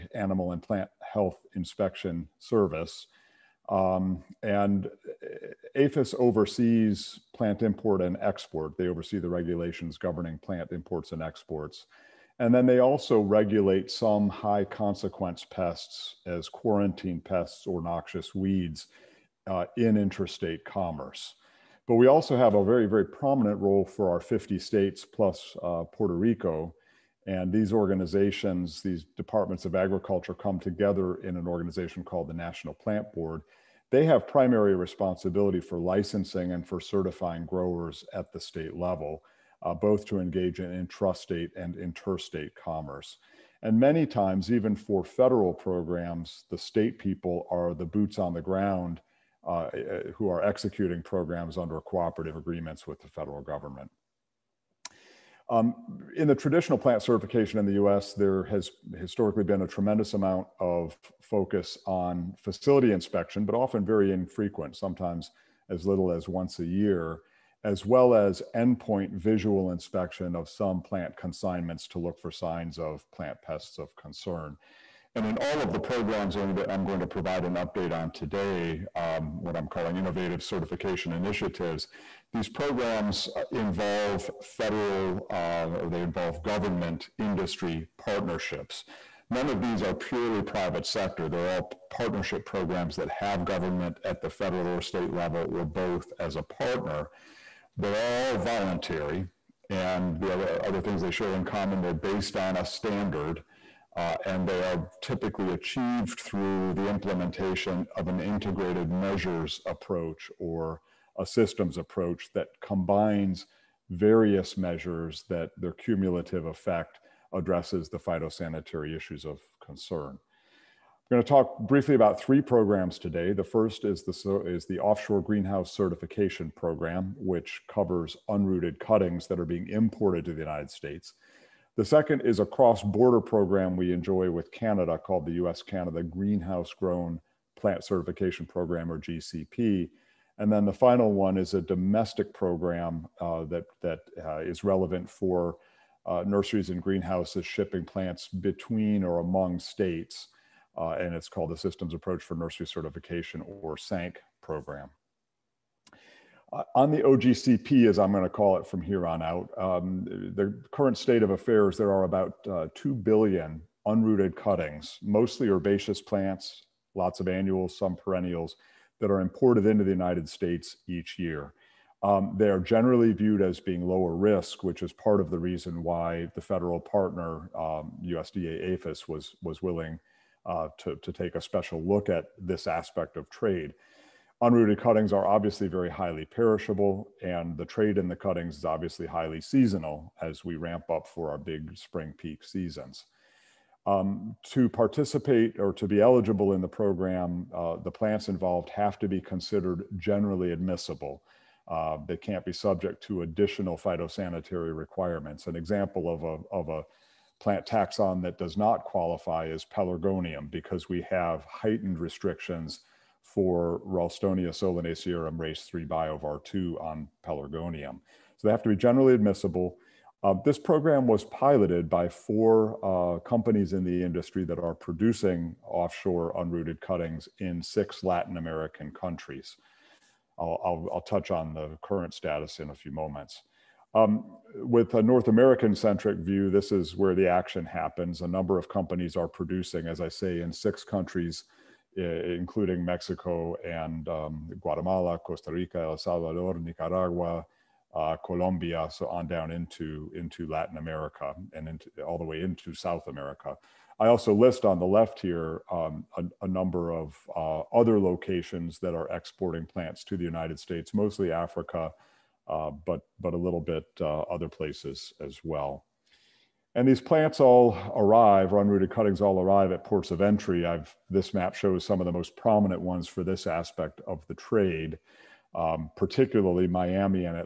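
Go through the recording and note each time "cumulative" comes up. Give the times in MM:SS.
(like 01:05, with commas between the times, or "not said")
01:55.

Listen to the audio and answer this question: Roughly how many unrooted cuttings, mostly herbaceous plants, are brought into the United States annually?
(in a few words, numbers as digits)
2 billion.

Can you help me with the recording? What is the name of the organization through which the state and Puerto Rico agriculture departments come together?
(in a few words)
National Plant Board.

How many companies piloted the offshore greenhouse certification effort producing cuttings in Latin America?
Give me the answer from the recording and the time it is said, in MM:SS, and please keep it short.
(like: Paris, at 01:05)
4, at 03:42.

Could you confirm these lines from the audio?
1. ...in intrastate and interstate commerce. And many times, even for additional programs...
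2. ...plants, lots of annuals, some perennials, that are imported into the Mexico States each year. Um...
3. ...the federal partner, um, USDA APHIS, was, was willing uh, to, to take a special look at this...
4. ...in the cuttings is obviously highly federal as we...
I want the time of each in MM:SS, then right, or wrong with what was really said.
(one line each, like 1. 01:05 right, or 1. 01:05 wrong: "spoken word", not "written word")
1. 00:40 wrong: "federal", not "additional"
2. 02:45 wrong: "United", not "Mexico"
3. 02:56 right
4. 03:07 wrong: "seasonal", not "federal".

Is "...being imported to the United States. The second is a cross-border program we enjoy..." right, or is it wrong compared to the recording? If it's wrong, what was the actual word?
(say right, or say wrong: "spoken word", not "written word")
right.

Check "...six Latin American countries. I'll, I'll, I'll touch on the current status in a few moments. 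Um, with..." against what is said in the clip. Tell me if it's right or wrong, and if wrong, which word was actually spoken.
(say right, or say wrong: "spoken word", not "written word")
right.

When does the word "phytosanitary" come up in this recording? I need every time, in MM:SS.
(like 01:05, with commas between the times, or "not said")
01:57, 03:23.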